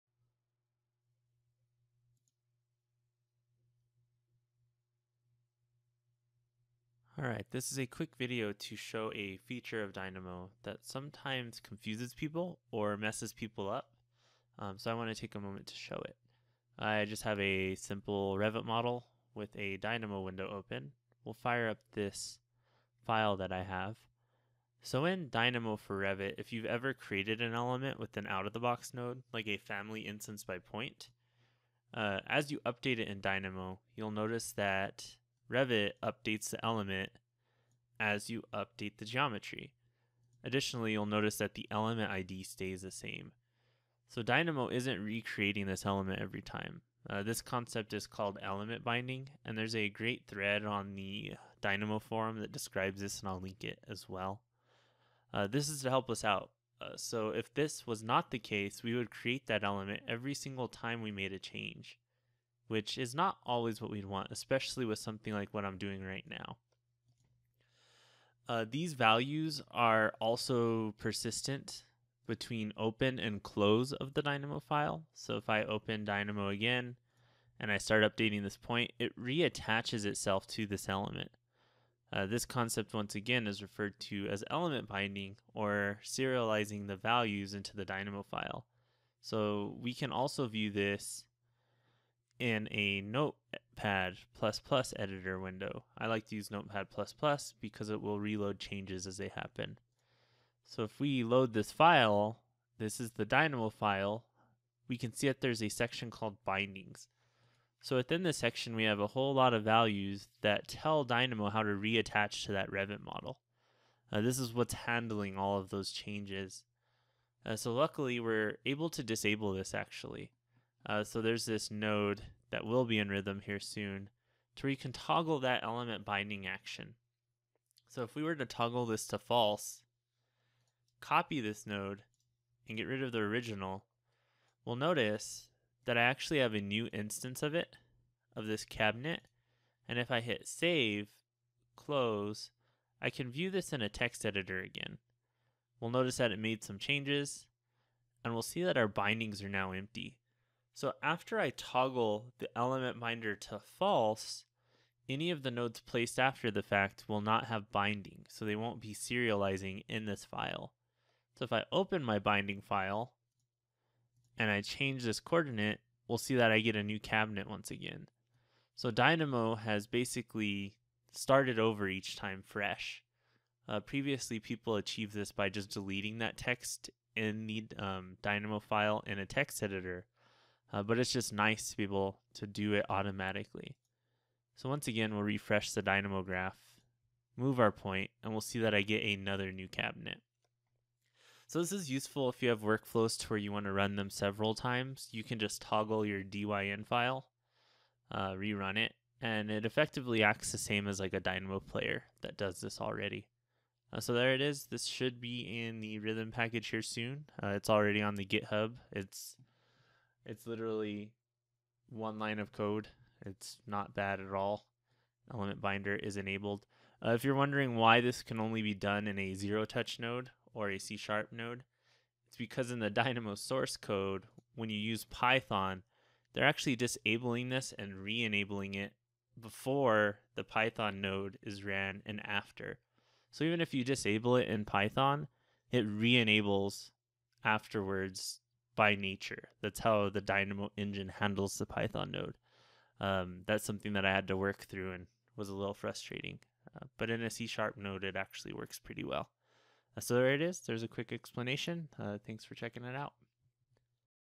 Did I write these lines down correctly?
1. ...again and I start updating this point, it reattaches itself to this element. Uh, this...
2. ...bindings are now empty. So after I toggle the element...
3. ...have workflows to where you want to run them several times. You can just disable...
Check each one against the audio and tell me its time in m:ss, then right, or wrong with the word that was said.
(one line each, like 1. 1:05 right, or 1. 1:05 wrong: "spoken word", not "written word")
1. 1:16 right
2. 2:28 right
3. 3:12 wrong: "toggle", not "disable".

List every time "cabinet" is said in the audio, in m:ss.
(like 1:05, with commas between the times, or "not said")
2:18, 2:46, 3:09.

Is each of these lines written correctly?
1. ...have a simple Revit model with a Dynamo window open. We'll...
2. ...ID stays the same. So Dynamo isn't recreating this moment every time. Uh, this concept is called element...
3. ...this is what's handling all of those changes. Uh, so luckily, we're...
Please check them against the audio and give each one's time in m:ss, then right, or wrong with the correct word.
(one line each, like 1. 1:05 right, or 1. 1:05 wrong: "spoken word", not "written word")
1. 0:17 right
2. 0:42 wrong: "element", not "moment"
3. 1:54 right.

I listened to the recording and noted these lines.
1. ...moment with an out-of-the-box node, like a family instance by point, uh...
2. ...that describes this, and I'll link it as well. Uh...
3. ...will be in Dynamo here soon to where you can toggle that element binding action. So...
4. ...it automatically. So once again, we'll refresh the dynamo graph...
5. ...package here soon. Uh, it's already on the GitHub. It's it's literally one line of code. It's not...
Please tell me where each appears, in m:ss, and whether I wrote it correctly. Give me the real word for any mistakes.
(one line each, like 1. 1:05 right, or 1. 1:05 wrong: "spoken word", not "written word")
1. 0:27 wrong: "element", not "moment"
2. 0:52 right
3. 2:02 wrong: "Rhythm", not "Dynamo"
4. 3:02 right
5. 3:26 right.